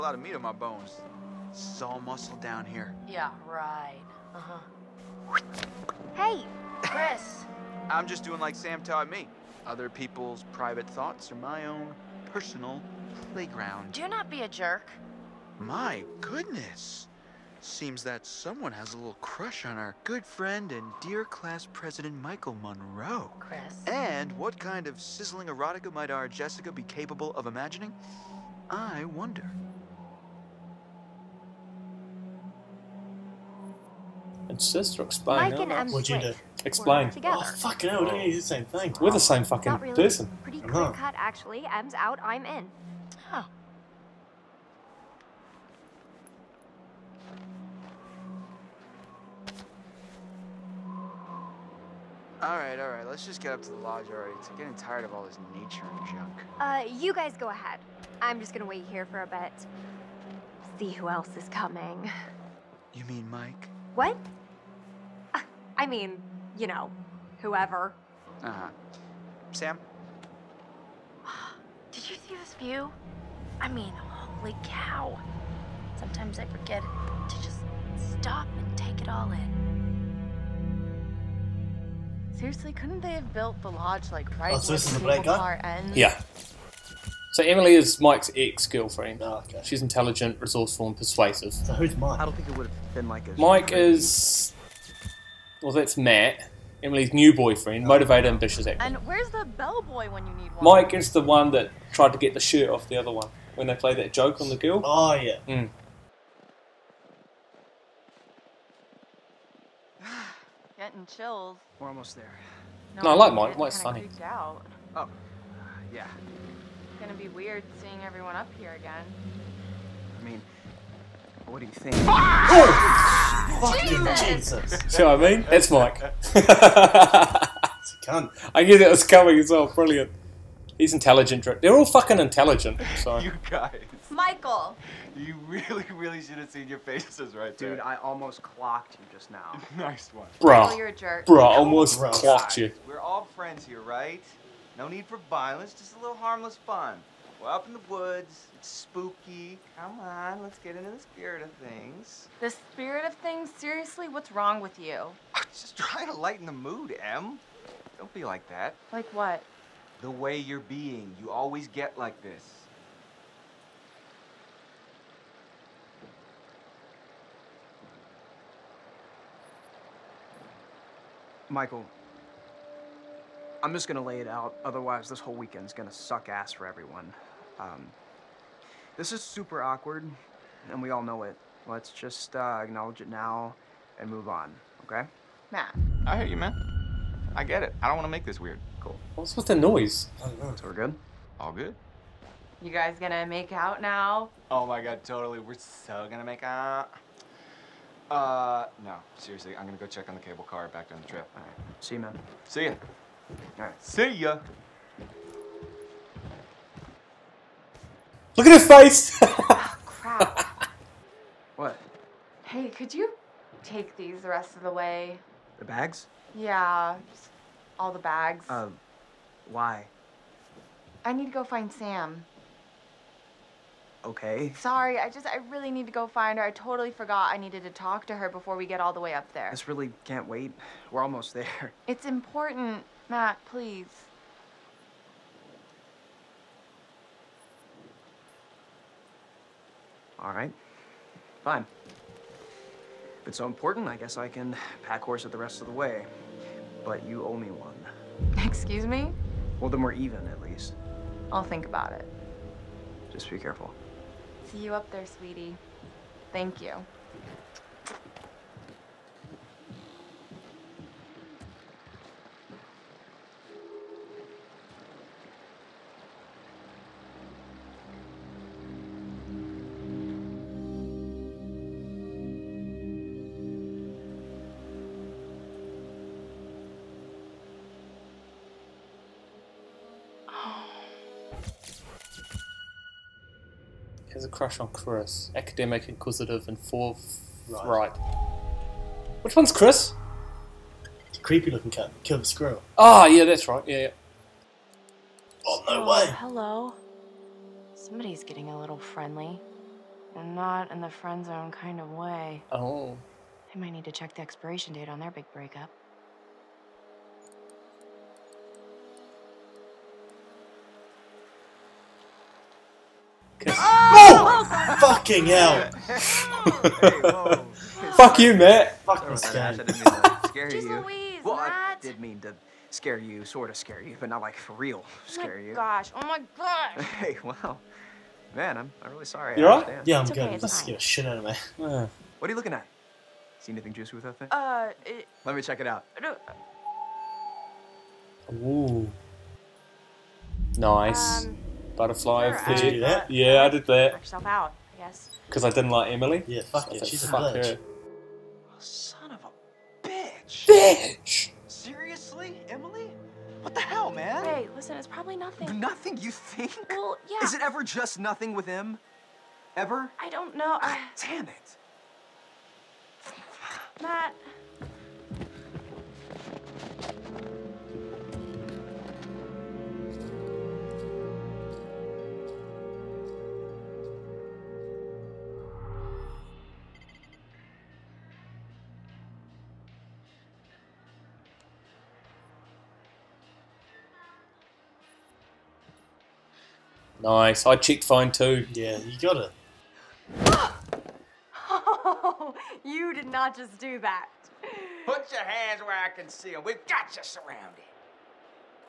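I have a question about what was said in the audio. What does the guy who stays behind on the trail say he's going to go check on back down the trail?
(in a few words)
The cable car.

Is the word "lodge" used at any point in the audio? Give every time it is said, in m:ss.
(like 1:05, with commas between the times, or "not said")
0:53, 1:23.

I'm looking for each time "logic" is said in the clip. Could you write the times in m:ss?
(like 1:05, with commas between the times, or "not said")
not said.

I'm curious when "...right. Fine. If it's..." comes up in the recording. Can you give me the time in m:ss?
4:00.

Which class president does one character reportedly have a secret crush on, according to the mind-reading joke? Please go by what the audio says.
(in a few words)
Michael Munroe.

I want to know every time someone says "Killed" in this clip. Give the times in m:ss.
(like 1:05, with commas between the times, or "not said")
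4:52.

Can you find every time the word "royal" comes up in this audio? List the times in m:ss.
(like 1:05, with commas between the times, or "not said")
not said.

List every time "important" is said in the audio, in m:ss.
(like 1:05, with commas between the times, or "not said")
3:52, 4:03.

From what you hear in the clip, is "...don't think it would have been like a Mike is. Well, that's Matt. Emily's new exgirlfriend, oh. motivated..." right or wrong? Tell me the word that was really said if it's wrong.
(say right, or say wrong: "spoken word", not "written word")
wrong: "boyfriend", not "exgirlfriend".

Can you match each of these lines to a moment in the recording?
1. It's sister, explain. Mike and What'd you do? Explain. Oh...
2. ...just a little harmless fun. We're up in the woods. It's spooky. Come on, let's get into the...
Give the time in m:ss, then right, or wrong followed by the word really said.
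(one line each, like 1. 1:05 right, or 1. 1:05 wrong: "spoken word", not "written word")
1. 0:34 right
2. 2:25 right.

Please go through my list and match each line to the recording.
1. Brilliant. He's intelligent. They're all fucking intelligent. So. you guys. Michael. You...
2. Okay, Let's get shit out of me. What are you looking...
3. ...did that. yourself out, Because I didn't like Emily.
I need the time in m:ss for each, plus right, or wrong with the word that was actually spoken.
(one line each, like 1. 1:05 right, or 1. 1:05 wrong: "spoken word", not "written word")
1. 2:09 right
2. 5:30 right
3. 5:43 right.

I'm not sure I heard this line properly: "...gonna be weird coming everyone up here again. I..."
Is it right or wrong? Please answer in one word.
wrong.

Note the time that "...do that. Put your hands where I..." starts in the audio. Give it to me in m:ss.
6:33.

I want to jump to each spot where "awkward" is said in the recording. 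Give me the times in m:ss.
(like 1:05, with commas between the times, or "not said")
2:59.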